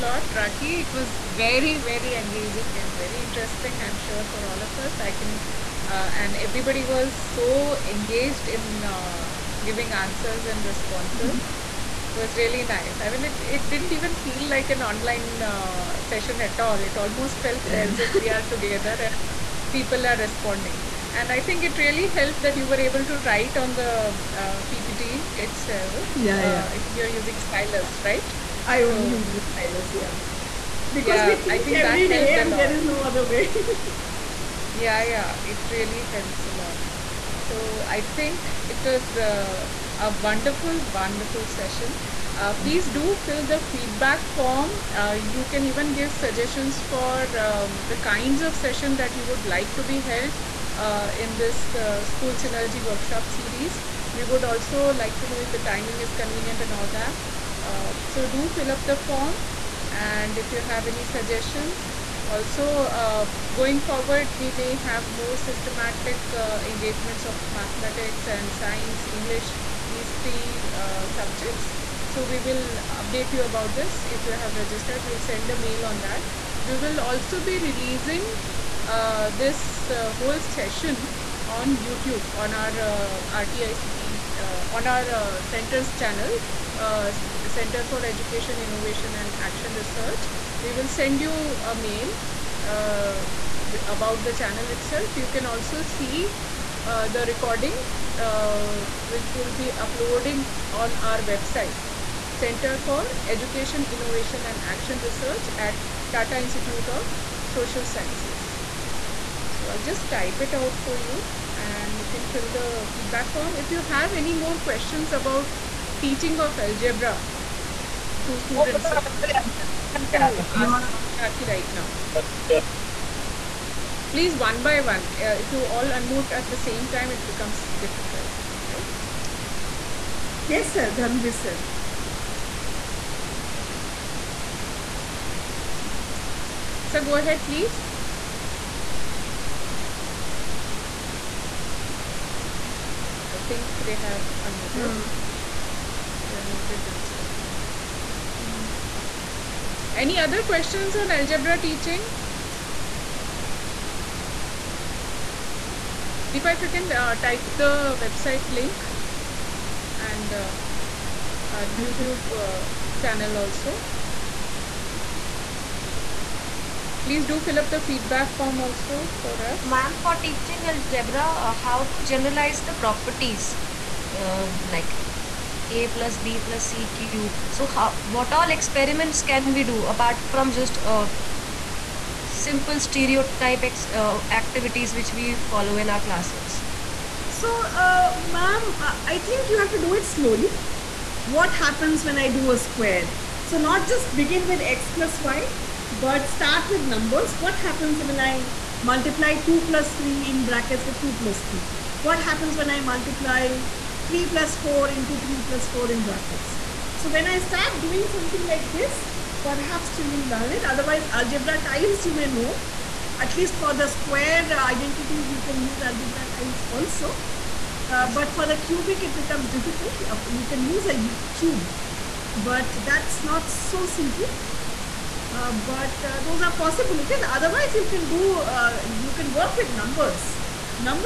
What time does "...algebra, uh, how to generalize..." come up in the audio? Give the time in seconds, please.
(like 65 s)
170 s.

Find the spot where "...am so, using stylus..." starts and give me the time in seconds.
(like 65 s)
28 s.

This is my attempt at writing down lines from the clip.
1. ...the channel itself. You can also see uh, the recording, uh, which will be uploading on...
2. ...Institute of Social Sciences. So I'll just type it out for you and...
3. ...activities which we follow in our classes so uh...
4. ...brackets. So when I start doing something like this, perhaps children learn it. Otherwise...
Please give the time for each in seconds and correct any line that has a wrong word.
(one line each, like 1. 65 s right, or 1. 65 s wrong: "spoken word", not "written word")
1. 94 s right
2. 106 s right
3. 184 s right
4. 206 s right.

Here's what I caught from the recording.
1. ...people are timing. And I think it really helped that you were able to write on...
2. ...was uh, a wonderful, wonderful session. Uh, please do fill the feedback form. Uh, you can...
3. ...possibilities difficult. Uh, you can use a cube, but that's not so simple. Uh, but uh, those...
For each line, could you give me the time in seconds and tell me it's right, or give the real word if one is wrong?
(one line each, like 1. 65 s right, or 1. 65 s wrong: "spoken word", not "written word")
1. 19 s wrong: "responding", not "timing"
2. 38 s right
3. 219 s wrong: "becomes", not "possibilities".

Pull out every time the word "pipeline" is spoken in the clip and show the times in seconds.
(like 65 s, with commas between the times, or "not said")
not said.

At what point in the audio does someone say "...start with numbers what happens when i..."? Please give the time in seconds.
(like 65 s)
196 s.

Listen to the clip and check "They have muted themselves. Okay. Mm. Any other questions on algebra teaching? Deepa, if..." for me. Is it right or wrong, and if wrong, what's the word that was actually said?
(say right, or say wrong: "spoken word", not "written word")
right.